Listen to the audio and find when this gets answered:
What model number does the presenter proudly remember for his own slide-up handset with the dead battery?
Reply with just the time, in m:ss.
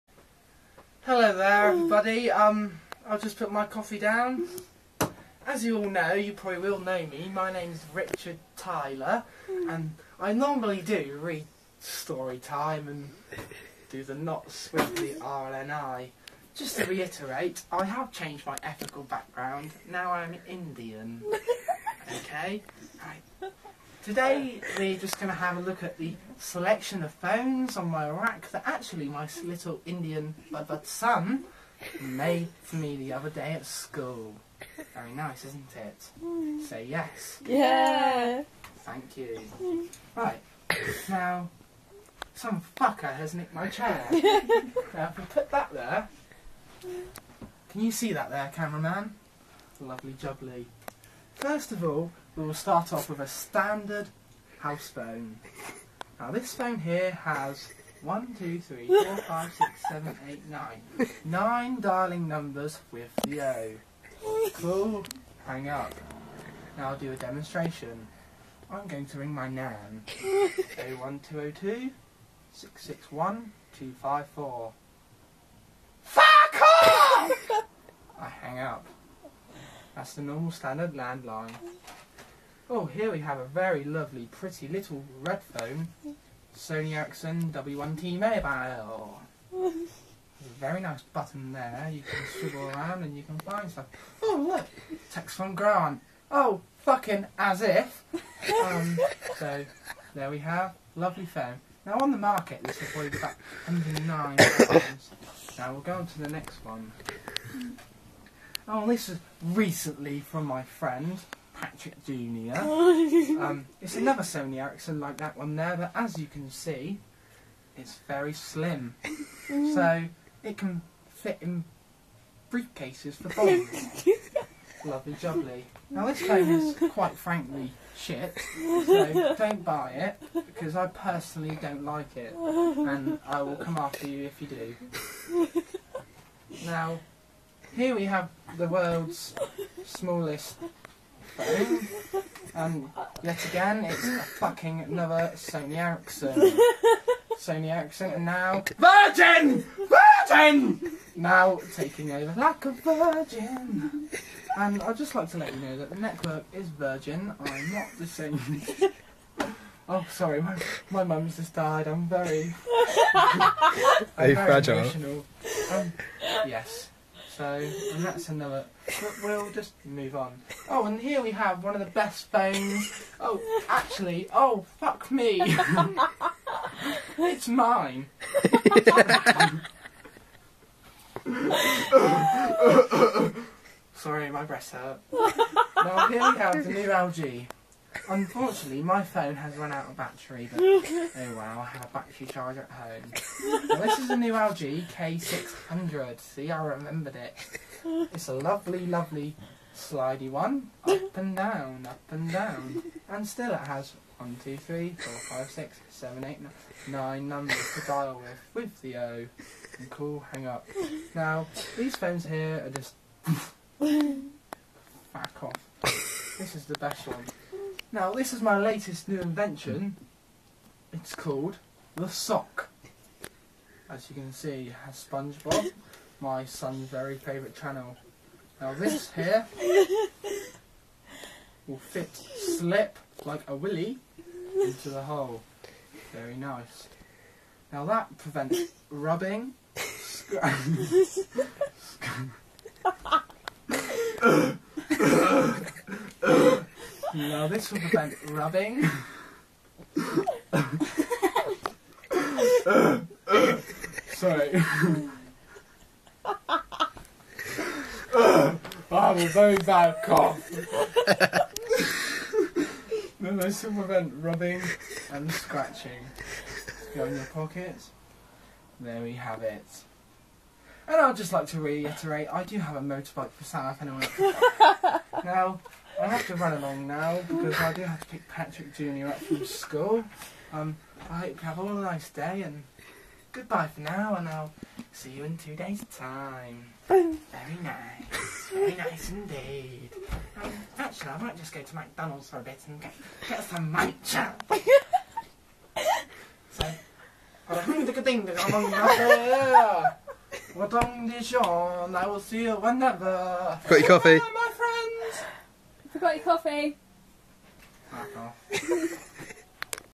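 3:14.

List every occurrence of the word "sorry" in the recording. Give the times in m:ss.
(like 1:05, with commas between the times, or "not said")
2:40, 3:03, 4:14.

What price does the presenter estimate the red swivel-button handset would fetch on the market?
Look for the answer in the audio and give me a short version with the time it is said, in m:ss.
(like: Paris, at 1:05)
109 pounds, at 1:43.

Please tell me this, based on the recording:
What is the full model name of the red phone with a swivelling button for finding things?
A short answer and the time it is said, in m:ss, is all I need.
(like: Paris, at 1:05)
Sony Ericsson W1T, at 1:26.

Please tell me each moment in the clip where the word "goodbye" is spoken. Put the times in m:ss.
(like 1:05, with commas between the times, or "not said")
4:43.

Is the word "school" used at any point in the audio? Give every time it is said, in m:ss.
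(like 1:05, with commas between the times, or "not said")
0:33, 4:39.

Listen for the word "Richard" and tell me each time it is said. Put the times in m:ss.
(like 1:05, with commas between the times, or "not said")
0:07.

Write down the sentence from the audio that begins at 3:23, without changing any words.
And still it has 1, 2, 3, 4, 5, 6, 7, 8, 9, numbers to dial with, with the O.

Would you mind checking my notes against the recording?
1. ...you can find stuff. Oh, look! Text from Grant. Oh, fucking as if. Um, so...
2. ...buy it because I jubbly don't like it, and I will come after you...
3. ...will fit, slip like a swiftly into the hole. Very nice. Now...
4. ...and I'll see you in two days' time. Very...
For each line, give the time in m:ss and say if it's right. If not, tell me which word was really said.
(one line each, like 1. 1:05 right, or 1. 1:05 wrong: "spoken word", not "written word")
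1. 1:33 right
2. 2:09 wrong: "personally", not "jubbly"
3. 3:51 wrong: "willy", not "swiftly"
4. 4:44 right.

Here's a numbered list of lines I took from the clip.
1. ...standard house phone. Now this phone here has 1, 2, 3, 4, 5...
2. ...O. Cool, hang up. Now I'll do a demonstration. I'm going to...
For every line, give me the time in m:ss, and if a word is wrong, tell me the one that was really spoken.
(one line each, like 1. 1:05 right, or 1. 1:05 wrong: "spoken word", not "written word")
1. 0:53 right
2. 1:03 right.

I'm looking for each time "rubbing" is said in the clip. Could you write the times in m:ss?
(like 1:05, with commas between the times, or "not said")
3:58, 4:08, 4:24.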